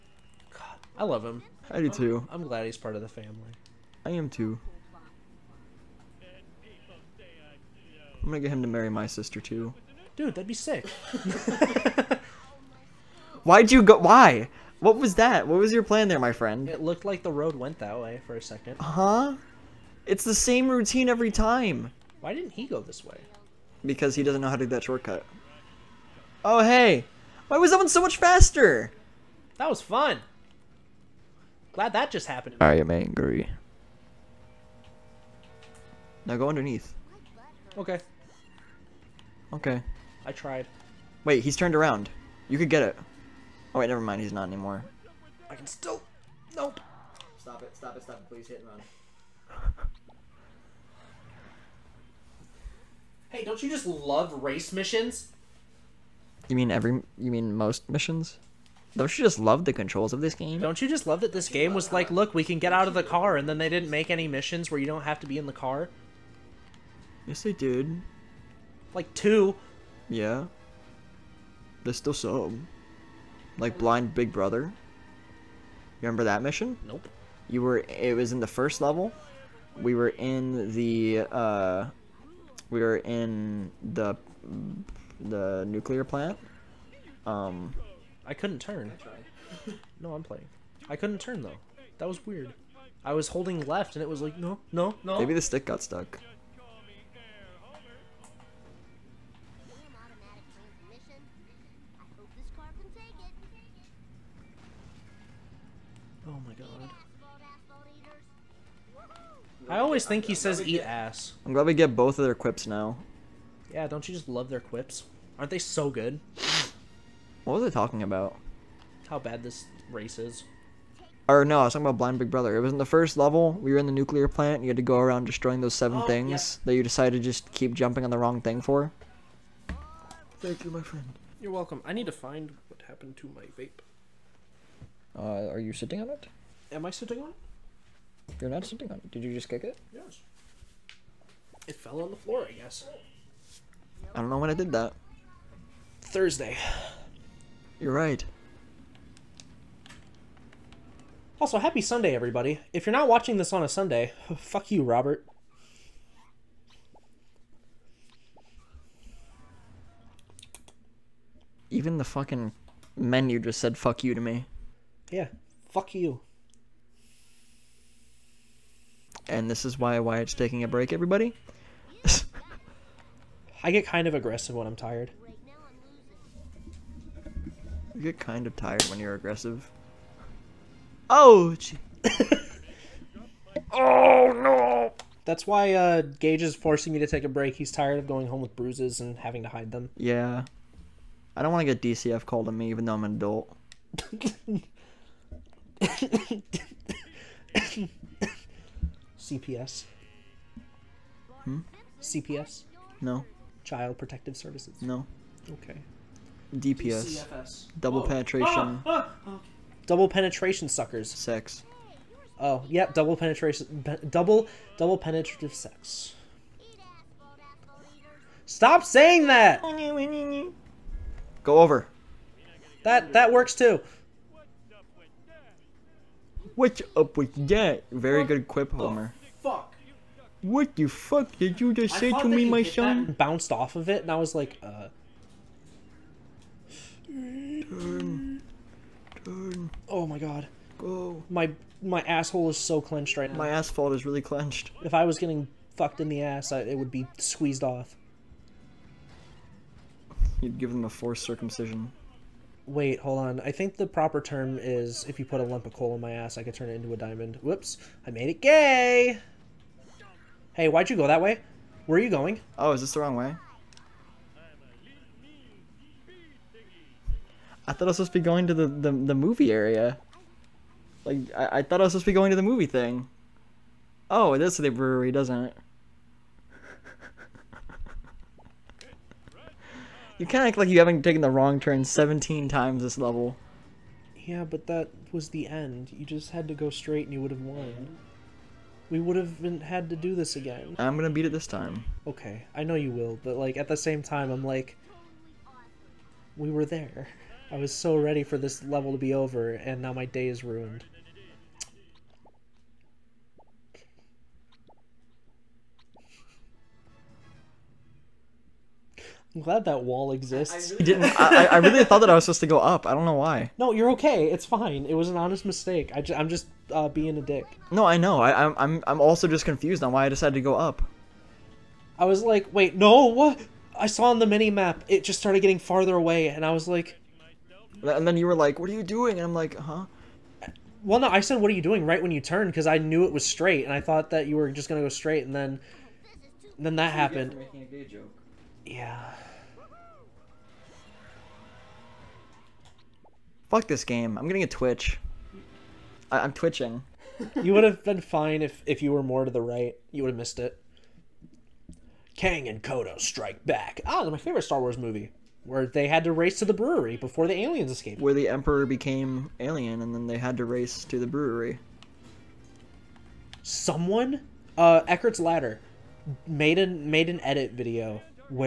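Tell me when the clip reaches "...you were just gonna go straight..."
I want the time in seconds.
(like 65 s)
334 s.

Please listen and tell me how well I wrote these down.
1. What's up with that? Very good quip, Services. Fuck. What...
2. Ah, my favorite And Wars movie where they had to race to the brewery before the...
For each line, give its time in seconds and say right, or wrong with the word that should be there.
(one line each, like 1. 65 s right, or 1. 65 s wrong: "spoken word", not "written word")
1. 226 s wrong: "Homer", not "Services"
2. 353 s wrong: "Star", not "And".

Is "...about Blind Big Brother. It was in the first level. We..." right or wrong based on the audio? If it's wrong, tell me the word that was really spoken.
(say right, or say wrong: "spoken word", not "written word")
right.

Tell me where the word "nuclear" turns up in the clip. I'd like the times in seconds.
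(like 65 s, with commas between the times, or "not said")
85 s, 123 s.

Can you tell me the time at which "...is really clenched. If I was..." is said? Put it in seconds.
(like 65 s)
243 s.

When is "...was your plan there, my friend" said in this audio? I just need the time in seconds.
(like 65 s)
15 s.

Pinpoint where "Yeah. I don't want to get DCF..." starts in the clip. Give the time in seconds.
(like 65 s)
189 s.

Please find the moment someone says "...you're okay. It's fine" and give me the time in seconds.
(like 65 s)
313 s.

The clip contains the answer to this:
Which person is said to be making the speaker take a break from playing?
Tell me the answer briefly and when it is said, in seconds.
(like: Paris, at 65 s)
Gage, at 186 s.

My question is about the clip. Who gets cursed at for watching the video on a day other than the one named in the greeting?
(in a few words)
Robert.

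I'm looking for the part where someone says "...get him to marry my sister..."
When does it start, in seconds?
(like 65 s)
8 s.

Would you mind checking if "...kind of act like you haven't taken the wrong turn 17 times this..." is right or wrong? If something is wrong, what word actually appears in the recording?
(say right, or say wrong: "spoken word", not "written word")
right.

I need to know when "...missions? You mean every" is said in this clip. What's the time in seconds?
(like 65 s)
54 s.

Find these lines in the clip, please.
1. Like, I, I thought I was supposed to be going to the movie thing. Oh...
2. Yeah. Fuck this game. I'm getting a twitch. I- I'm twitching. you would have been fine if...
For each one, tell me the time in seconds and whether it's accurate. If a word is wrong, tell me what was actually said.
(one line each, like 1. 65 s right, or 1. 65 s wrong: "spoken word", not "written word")
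1. 271 s right
2. 338 s right.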